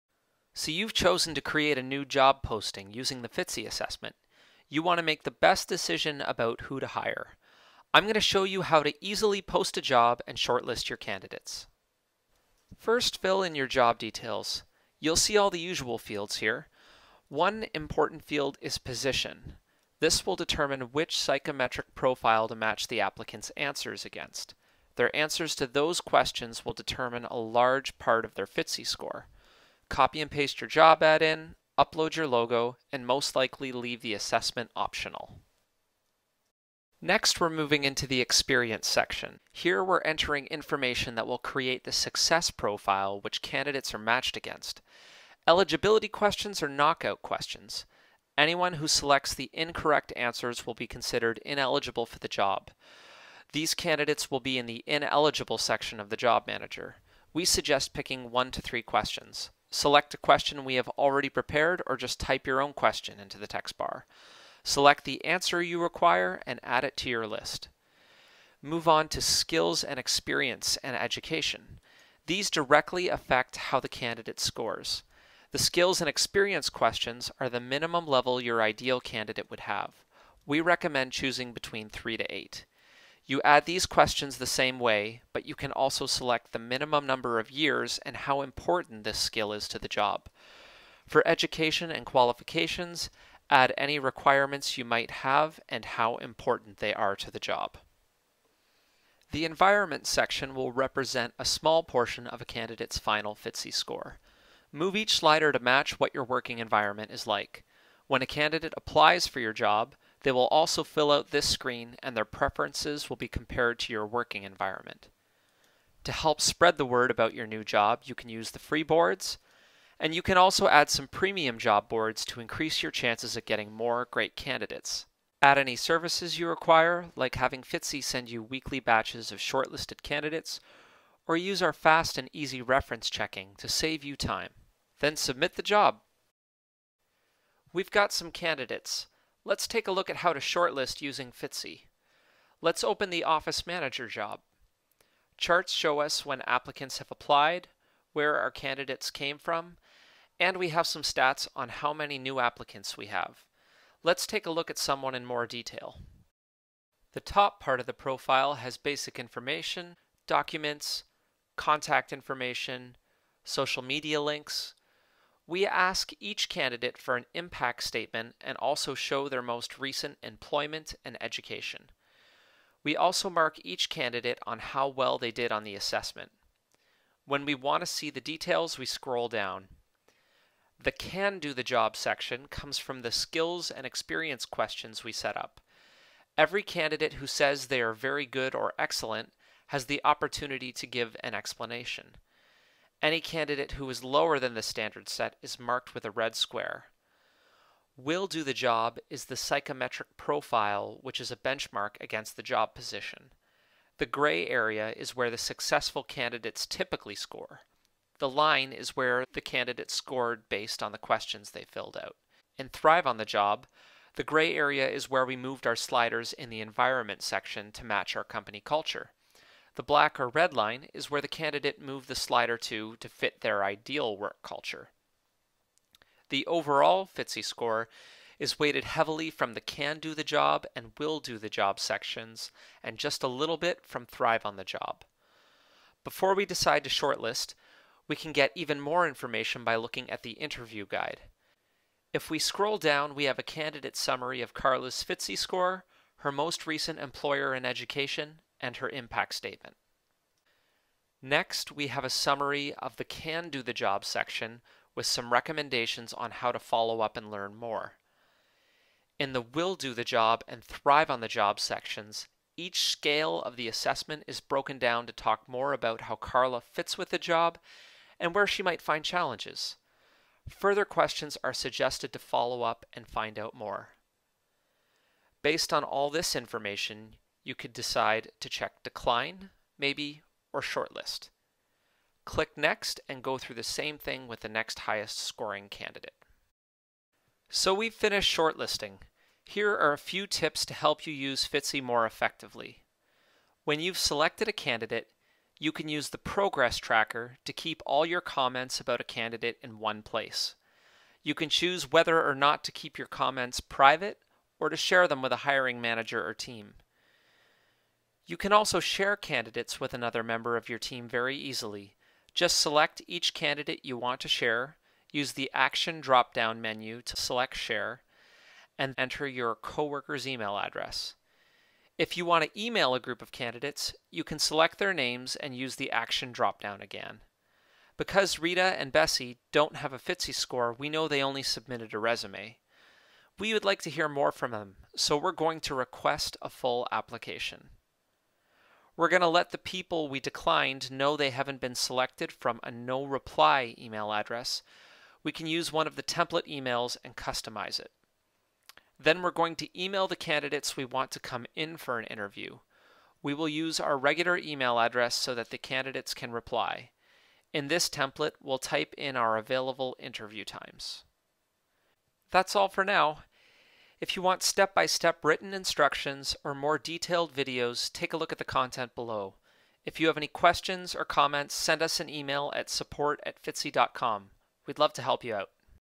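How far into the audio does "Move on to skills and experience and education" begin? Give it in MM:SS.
01:08.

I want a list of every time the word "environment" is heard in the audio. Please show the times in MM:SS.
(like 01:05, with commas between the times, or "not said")
01:39, 01:46, 01:54, 03:36.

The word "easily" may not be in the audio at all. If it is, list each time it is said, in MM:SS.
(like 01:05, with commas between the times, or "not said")
00:09, 05:11.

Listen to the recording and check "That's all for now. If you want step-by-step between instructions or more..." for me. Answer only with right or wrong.
wrong.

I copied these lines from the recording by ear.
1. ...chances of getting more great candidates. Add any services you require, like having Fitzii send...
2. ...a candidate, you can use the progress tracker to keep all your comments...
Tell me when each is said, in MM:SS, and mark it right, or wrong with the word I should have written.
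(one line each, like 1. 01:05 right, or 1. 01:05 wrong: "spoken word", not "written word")
1. 02:02 right
2. 04:54 right.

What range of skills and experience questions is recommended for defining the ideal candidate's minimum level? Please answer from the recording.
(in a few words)
3 to 8.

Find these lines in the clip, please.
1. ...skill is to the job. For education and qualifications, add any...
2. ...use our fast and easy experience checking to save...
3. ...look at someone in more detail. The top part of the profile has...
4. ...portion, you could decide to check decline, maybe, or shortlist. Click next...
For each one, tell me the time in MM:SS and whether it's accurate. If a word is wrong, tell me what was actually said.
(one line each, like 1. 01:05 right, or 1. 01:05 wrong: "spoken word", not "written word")
1. 01:29 right
2. 02:11 wrong: "reference", not "experience"
3. 02:34 right
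4. 04:36 wrong: "information", not "portion".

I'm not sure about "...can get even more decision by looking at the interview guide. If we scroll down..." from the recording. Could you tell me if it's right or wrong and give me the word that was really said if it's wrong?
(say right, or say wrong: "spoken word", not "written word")
wrong: "information", not "decision".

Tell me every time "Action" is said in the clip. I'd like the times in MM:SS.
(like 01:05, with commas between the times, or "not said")
05:15, 05:25.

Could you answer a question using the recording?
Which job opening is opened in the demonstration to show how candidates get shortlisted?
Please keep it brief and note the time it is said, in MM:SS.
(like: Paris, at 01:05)
Office Manager, at 02:23.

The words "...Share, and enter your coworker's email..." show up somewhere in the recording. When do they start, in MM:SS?
05:17.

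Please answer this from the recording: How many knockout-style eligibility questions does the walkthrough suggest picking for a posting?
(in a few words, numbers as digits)
1 to 3.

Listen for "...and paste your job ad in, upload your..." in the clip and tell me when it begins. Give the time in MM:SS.
00:30.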